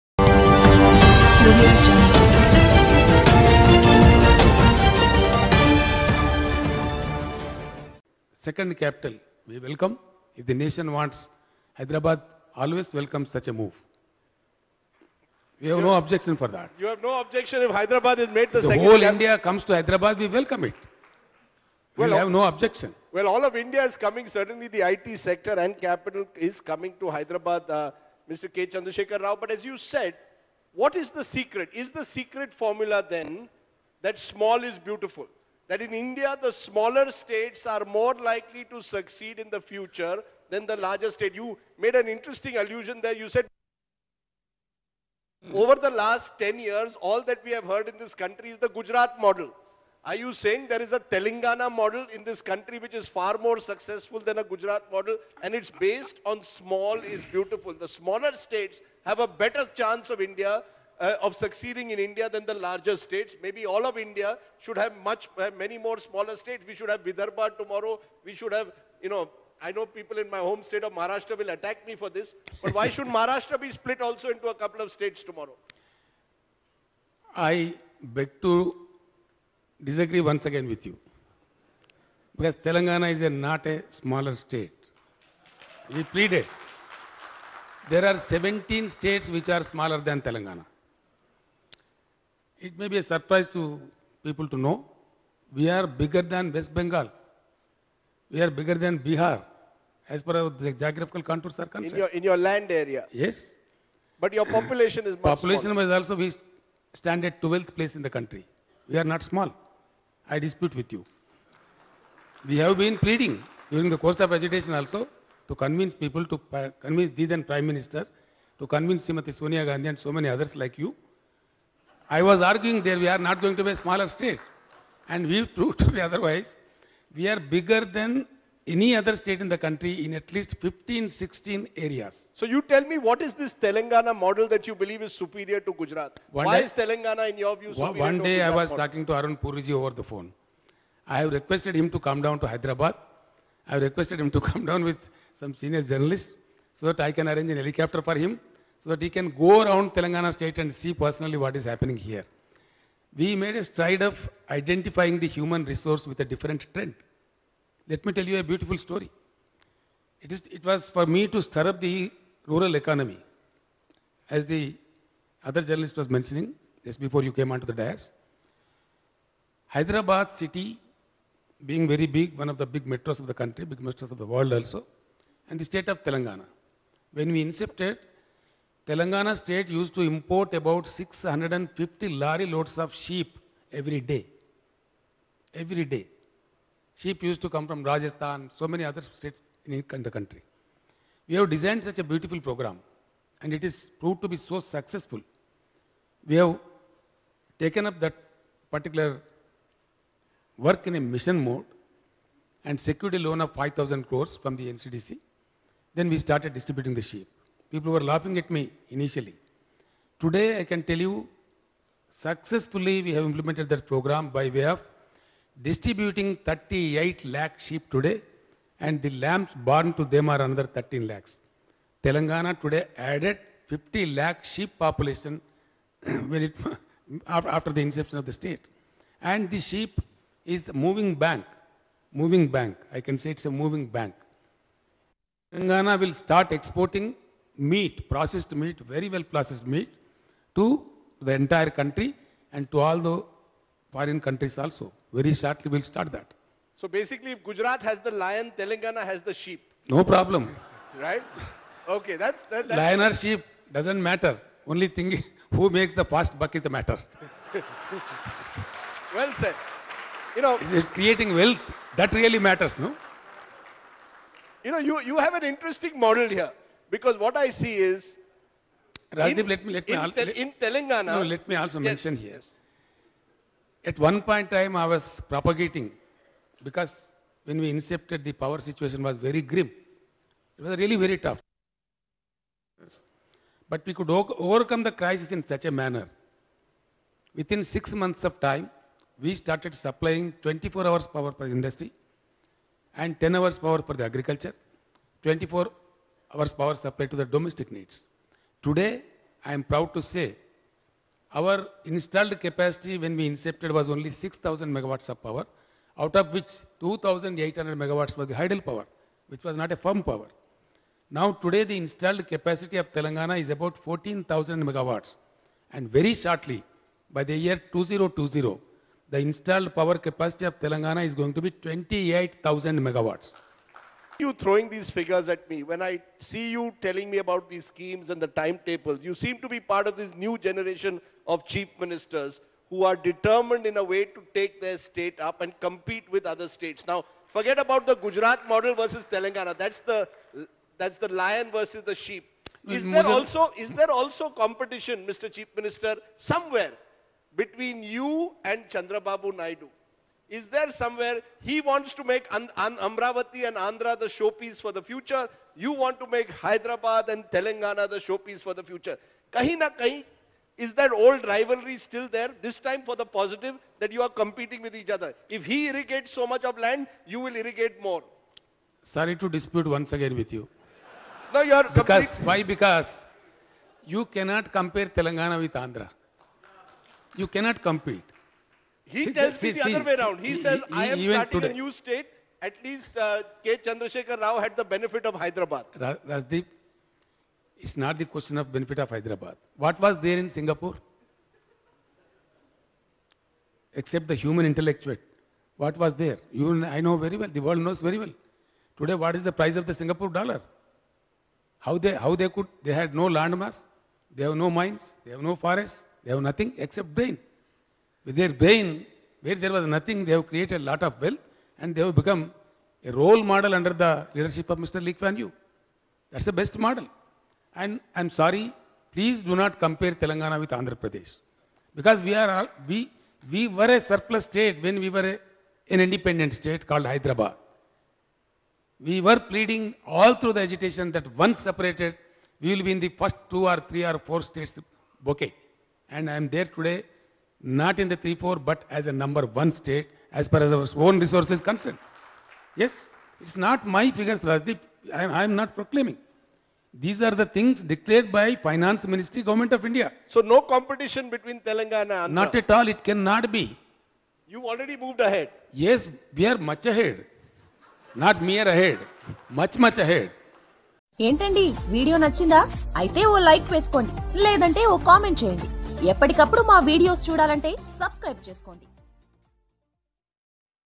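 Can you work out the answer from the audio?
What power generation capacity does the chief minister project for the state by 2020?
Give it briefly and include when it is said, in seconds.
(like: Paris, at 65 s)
28,000 megawatts, at 321 s.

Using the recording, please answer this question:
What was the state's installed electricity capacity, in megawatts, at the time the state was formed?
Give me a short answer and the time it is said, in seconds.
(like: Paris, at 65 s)
6,000 megawatts, at 304 s.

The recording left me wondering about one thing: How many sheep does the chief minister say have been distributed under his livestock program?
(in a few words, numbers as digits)
38 lakh.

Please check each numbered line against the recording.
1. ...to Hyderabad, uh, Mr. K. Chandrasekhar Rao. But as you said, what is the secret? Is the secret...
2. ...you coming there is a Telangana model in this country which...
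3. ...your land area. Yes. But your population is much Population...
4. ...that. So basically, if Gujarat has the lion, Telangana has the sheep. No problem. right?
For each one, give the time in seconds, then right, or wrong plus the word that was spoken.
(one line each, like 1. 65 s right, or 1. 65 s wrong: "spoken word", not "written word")
1. 27 s right
2. 50 s wrong: "saying", not "coming"
3. 102 s right
4. 246 s right.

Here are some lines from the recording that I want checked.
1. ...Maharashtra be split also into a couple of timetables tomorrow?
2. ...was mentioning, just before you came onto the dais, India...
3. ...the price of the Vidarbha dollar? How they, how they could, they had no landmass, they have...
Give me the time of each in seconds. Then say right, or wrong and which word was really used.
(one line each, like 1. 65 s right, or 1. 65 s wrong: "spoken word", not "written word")
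1. 73 s wrong: "states", not "timetables"
2. 166 s wrong: "Hyderabad", not "India"
3. 399 s wrong: "Singapore", not "Vidarbha".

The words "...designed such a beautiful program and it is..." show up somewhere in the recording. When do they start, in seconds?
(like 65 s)
191 s.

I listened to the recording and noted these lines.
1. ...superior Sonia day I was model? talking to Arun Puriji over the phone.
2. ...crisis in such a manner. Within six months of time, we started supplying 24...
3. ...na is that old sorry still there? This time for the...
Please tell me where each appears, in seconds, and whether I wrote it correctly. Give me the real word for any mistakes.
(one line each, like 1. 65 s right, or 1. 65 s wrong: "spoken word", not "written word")
1. 137 s wrong: "One", not "Sonia"
2. 284 s right
3. 359 s wrong: "rivalry", not "sorry".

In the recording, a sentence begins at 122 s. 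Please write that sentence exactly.
I was arguing there we are not going to be a smaller state.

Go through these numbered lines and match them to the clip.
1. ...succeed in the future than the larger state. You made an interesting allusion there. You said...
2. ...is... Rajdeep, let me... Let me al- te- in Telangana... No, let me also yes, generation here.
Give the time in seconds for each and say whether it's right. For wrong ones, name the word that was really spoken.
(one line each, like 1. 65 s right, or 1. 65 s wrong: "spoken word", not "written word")
1. 38 s right
2. 267 s wrong: "mention", not "generation".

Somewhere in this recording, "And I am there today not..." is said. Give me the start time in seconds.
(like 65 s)
435 s.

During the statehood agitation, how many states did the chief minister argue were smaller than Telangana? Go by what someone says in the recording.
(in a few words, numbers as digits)
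17.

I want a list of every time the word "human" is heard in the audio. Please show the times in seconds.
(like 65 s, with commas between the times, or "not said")
155 s, 394 s.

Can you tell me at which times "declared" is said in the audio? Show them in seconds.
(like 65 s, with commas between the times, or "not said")
447 s.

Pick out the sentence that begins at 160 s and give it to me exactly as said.
It, is, it was for me to stir up the rural economy.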